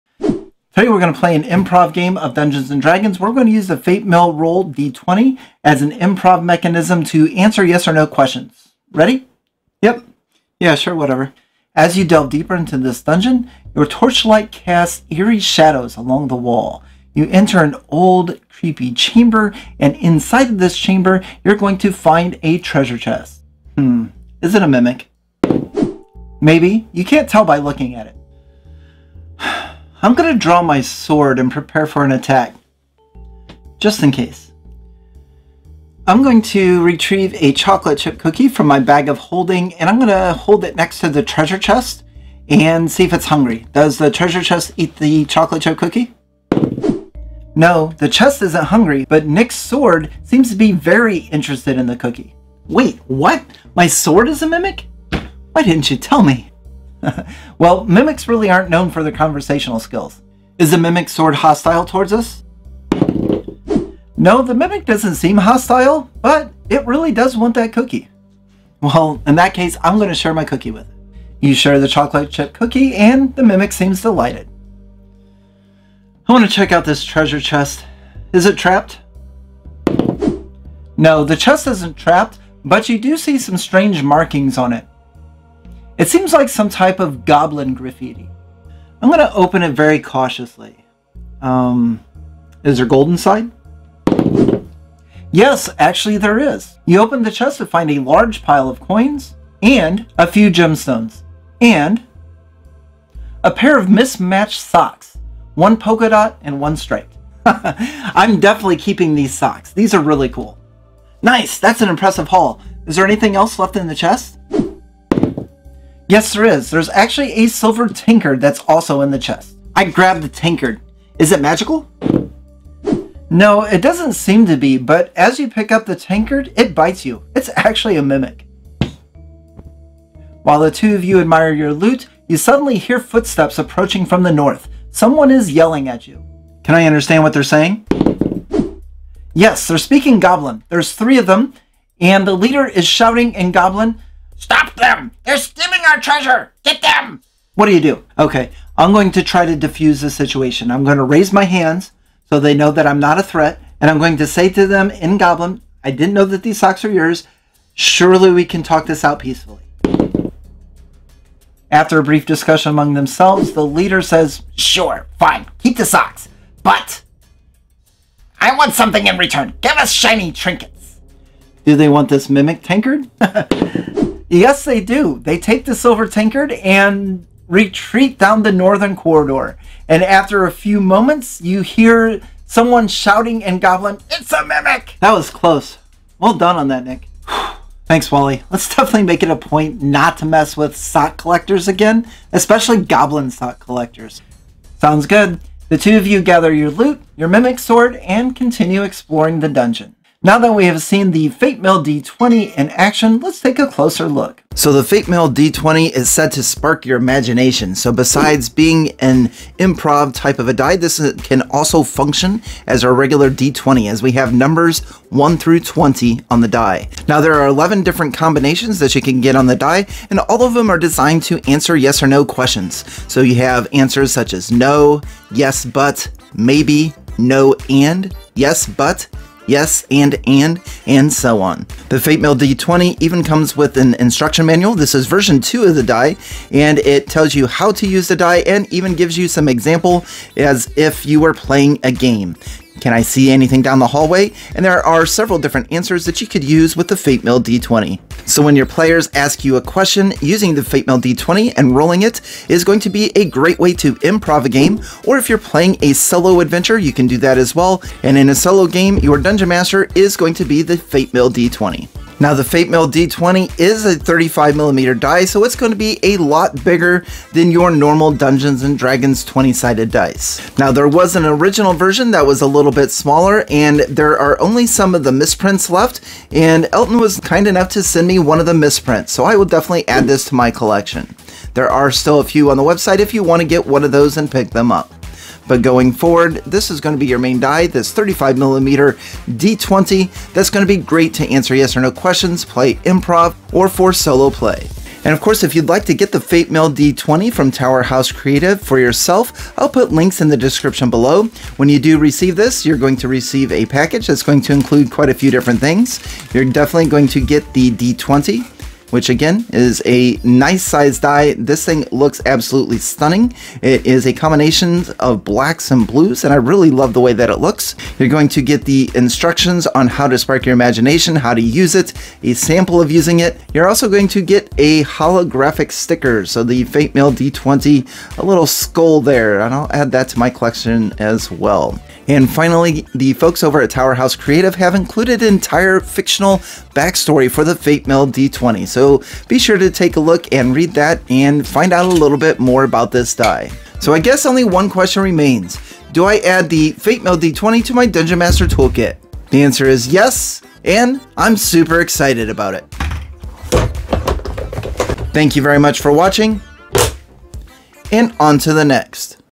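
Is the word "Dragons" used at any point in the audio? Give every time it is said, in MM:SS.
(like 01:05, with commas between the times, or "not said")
00:02, 04:28.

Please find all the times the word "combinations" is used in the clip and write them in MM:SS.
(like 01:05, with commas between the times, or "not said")
03:38, 05:14.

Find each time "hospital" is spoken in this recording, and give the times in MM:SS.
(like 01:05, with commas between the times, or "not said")
not said.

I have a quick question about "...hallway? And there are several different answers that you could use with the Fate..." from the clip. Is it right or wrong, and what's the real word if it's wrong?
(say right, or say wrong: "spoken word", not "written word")
right.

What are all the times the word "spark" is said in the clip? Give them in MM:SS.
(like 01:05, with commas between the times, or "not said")
03:26, 05:20.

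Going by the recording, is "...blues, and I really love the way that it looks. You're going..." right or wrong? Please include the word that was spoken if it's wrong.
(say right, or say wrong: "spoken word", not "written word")
right.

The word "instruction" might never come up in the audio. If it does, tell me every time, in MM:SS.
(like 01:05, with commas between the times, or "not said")
03:53, 05:18.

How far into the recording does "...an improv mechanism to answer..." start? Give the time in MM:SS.
00:05.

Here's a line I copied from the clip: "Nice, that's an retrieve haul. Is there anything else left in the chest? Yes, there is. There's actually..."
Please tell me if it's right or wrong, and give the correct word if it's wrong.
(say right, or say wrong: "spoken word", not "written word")
wrong: "impressive", not "retrieve".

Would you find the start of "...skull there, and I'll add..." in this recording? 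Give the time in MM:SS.
05:28.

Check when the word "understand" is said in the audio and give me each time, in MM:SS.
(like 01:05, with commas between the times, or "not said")
02:16.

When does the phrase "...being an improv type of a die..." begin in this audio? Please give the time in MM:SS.
03:28.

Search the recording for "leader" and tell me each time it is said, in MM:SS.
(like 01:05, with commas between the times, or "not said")
02:22, 02:43.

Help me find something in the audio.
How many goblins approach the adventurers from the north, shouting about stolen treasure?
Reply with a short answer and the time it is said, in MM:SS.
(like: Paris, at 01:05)
3, at 02:20.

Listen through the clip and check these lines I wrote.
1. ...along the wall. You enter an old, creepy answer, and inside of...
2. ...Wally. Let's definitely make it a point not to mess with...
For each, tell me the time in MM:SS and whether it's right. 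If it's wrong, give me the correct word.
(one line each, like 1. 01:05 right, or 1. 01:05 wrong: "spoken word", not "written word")
1. 00:15 wrong: "chamber", not "answer"
2. 03:08 right.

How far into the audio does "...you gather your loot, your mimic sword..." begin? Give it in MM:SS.
03:16.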